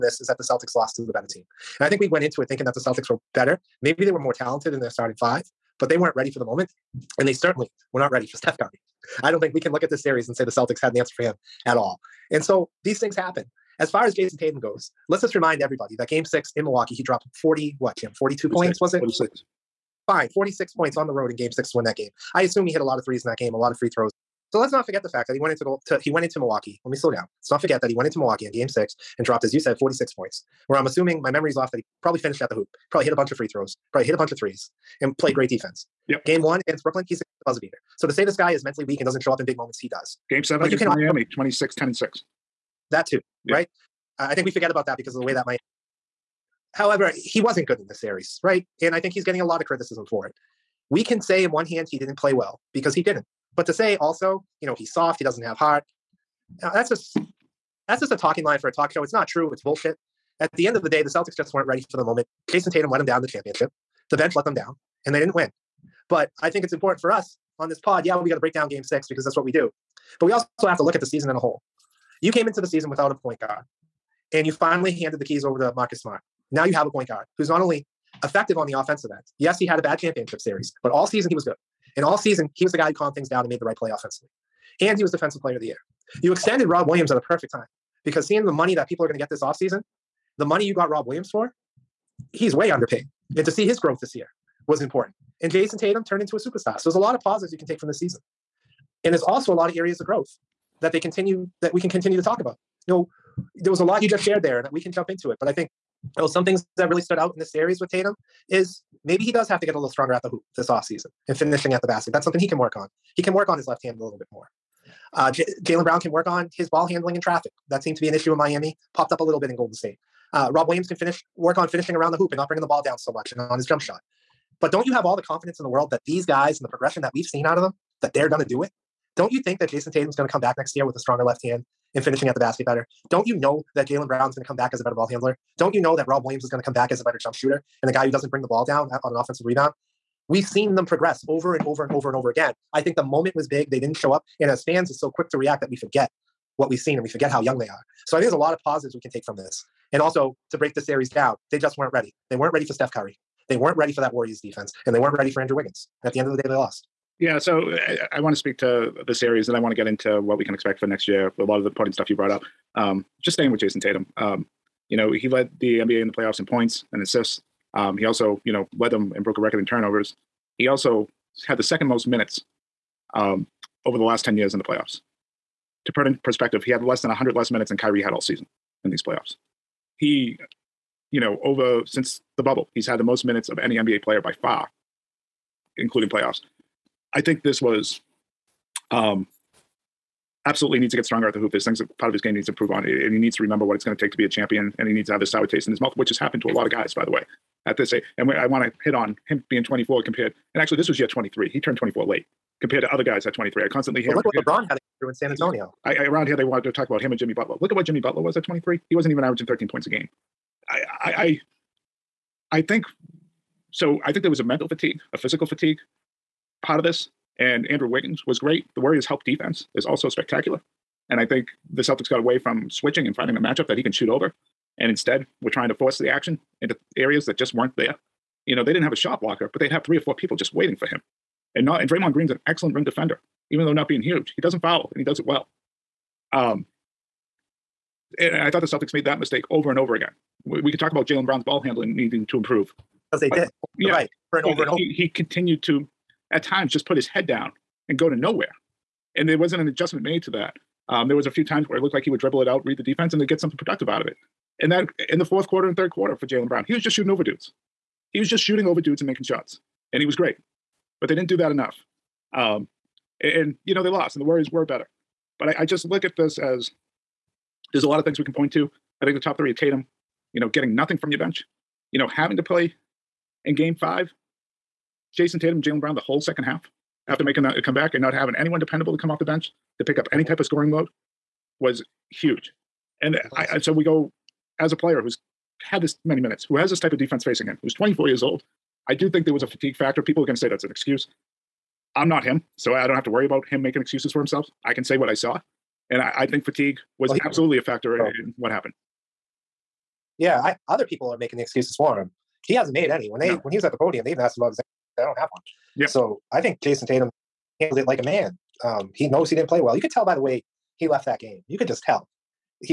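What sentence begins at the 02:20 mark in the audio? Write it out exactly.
We've seen them progress over and over and over and over again.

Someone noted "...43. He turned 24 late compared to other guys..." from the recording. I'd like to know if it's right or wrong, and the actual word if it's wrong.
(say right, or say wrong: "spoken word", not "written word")
wrong: "23", not "43".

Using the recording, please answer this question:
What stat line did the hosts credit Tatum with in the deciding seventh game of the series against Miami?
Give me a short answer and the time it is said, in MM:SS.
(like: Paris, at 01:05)
26, 10, and 6, at 00:41.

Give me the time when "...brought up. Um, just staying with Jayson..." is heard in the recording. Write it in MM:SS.
02:42.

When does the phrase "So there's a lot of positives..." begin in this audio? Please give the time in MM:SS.
01:36.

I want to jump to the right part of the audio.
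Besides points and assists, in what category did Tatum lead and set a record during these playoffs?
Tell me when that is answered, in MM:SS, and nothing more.
02:49.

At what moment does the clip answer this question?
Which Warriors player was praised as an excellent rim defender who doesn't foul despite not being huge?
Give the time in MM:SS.
03:51.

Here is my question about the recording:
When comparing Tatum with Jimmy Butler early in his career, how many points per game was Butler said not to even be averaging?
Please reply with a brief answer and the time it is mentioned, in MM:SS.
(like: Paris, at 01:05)
13 points, at 03:29.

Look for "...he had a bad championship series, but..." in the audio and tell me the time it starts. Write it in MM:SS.
01:19.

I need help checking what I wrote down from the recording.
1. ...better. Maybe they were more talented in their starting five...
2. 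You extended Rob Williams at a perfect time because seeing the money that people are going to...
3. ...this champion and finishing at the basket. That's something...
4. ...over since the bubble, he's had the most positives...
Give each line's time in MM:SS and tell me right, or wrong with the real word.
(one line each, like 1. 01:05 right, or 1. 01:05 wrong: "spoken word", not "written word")
1. 00:03 right
2. 01:26 right
3. 01:50 wrong: "offseason", not "champion"
4. 03:01 wrong: "minutes", not "positives".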